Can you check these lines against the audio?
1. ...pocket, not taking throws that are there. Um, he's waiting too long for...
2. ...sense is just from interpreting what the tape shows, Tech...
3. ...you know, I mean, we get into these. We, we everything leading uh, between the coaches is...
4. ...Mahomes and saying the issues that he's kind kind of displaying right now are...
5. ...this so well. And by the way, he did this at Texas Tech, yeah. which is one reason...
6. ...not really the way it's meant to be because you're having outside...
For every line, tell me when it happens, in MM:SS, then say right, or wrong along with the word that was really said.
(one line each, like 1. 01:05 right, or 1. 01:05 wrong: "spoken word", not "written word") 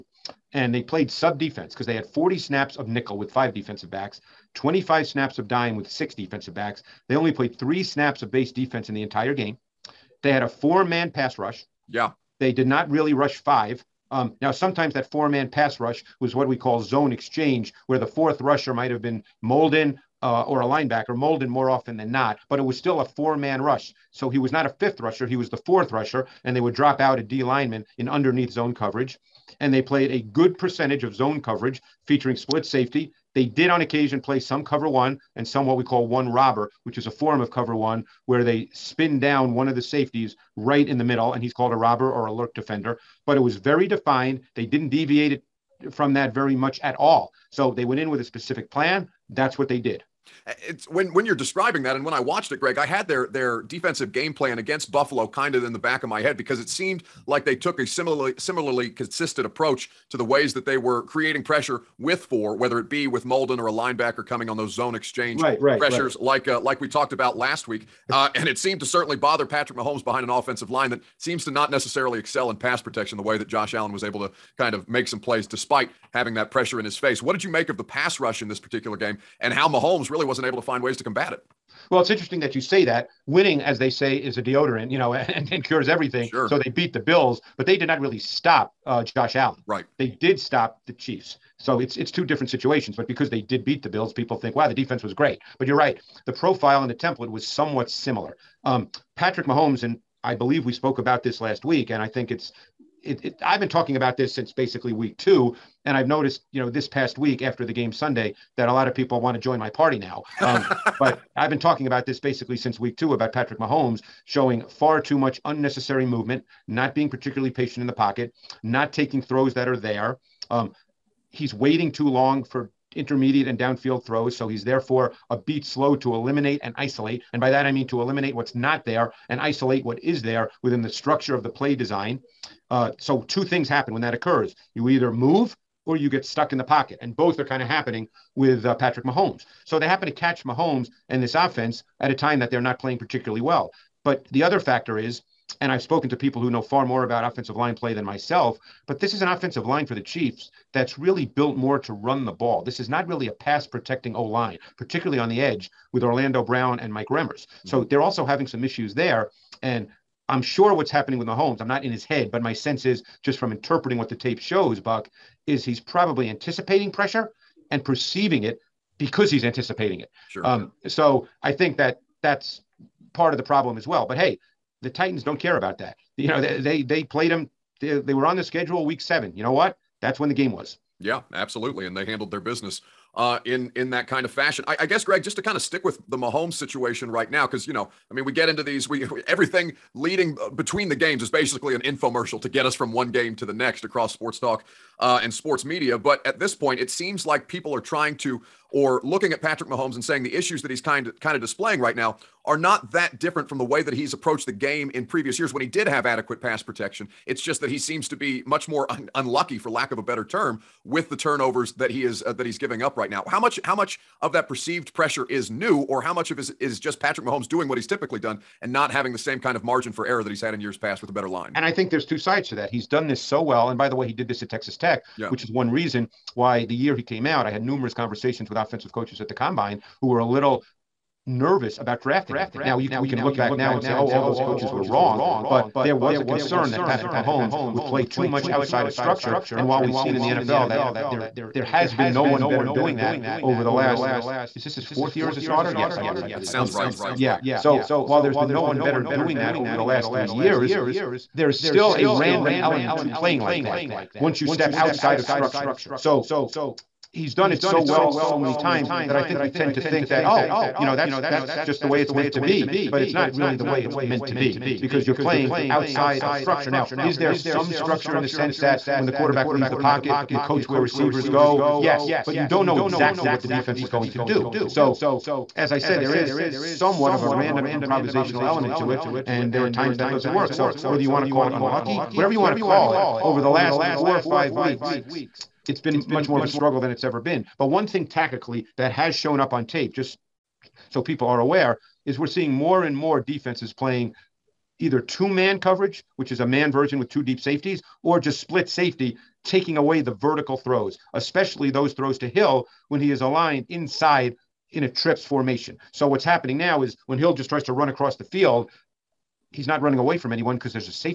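1. 01:57 right
2. 02:42 wrong: "Buck", not "Tech"
3. 03:07 wrong: "games", not "coaches"
4. 03:19 right
5. 03:43 right
6. 04:23 wrong: "playing", not "having".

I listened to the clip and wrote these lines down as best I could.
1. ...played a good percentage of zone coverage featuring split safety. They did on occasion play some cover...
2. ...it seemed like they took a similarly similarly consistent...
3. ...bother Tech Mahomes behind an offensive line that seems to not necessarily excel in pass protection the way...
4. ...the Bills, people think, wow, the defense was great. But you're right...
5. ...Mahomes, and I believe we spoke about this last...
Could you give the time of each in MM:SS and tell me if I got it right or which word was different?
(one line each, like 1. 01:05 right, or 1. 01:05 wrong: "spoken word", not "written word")
1. 00:29 right
2. 00:56 right
3. 01:09 wrong: "Patrick", not "Tech"
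4. 01:33 right
5. 01:39 right.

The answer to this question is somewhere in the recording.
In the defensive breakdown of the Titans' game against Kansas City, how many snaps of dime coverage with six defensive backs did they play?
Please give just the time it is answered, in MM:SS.
00:04.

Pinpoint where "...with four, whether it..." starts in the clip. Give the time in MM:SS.
01:01.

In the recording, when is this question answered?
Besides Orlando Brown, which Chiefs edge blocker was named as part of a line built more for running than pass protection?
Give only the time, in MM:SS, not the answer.
02:36.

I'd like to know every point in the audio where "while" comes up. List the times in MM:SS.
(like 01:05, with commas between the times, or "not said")
03:59, 04:08.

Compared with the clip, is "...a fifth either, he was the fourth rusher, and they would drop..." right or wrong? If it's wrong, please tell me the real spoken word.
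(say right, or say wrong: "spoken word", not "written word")
wrong: "rusher", not "either".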